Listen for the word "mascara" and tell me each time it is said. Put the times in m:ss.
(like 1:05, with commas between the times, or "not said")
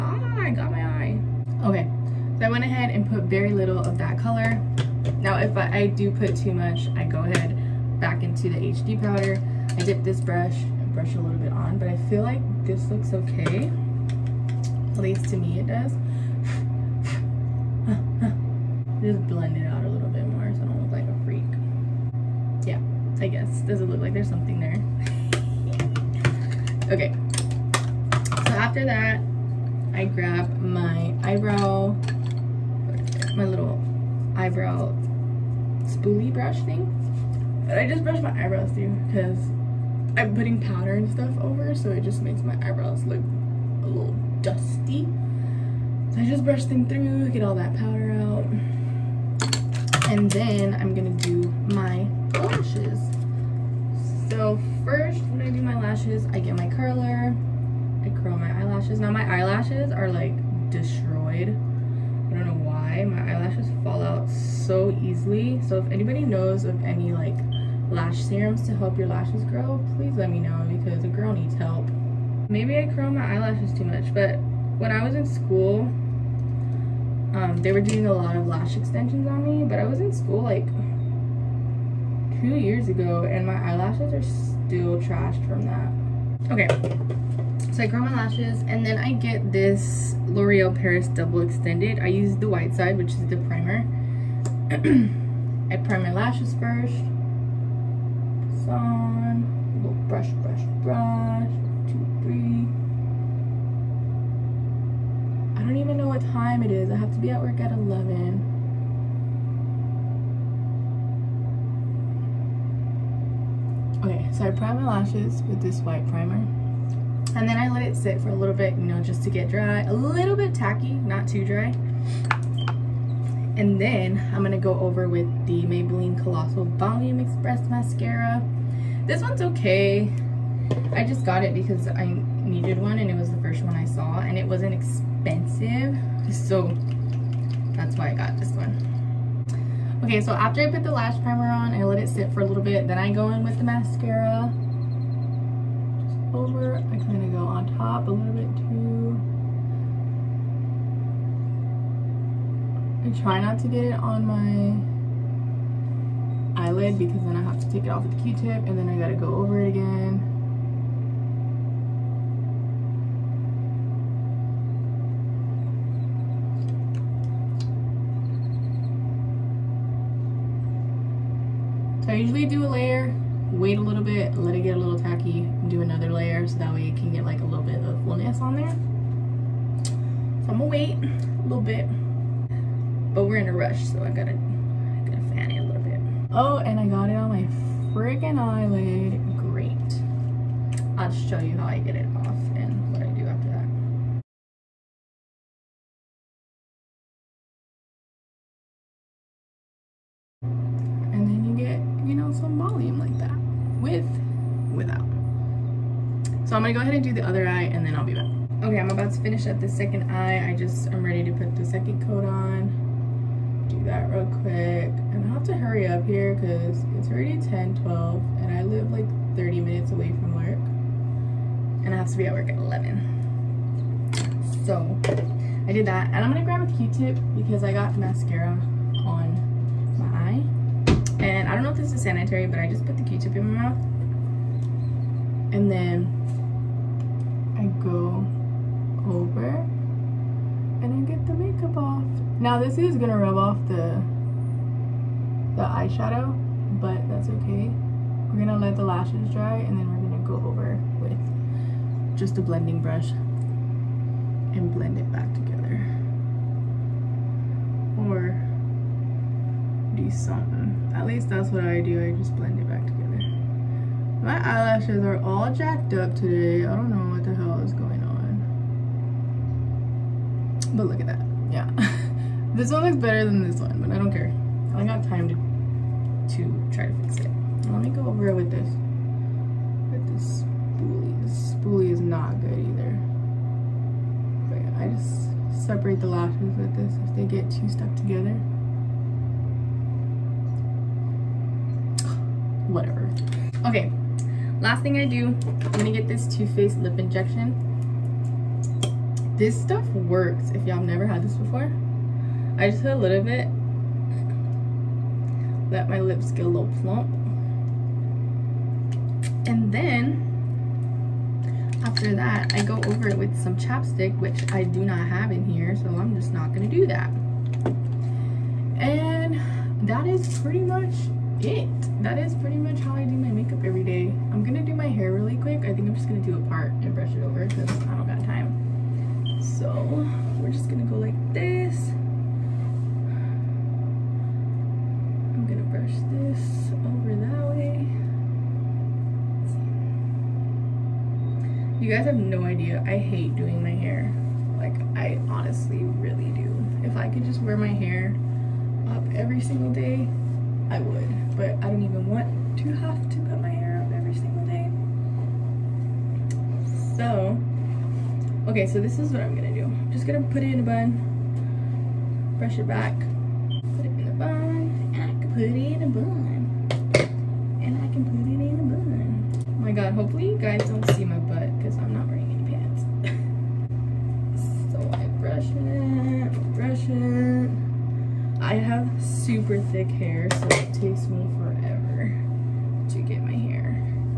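2:07, 2:23, 3:47.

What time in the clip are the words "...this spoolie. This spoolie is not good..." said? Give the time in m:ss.
4:40.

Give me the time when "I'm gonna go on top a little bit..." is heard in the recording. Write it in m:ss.
2:26.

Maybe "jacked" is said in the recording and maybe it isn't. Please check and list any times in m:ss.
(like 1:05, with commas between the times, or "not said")
4:25.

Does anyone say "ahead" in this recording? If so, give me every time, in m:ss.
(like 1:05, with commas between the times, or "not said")
0:02, 0:07, 3:26.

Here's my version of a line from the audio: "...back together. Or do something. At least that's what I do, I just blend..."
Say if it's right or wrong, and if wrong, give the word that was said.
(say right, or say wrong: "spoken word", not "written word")
right.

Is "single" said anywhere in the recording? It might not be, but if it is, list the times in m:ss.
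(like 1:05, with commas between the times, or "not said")
5:49, 5:54.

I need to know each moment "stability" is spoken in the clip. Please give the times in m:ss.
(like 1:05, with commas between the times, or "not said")
not said.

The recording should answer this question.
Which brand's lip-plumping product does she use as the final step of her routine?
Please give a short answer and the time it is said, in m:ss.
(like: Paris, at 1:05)
Too Faced, at 4:56.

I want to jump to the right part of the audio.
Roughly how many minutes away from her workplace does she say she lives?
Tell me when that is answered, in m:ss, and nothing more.
3:39.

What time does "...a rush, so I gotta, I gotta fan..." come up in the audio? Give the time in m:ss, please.
3:03.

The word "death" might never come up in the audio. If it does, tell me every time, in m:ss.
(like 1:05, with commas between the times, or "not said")
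not said.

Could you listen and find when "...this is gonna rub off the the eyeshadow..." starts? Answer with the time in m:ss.
4:02.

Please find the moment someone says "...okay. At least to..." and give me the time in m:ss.
0:13.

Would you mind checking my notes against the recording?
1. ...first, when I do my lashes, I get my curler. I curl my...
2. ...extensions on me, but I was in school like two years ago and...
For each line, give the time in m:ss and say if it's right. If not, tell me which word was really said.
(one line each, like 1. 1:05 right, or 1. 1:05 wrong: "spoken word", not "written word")
1. 0:54 right
2. 1:18 right.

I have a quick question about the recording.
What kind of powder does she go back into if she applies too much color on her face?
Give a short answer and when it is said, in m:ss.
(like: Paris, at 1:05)
HD powder, at 0:08.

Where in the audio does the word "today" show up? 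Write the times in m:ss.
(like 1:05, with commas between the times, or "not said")
4:26.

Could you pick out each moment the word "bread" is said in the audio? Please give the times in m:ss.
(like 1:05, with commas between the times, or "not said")
not said.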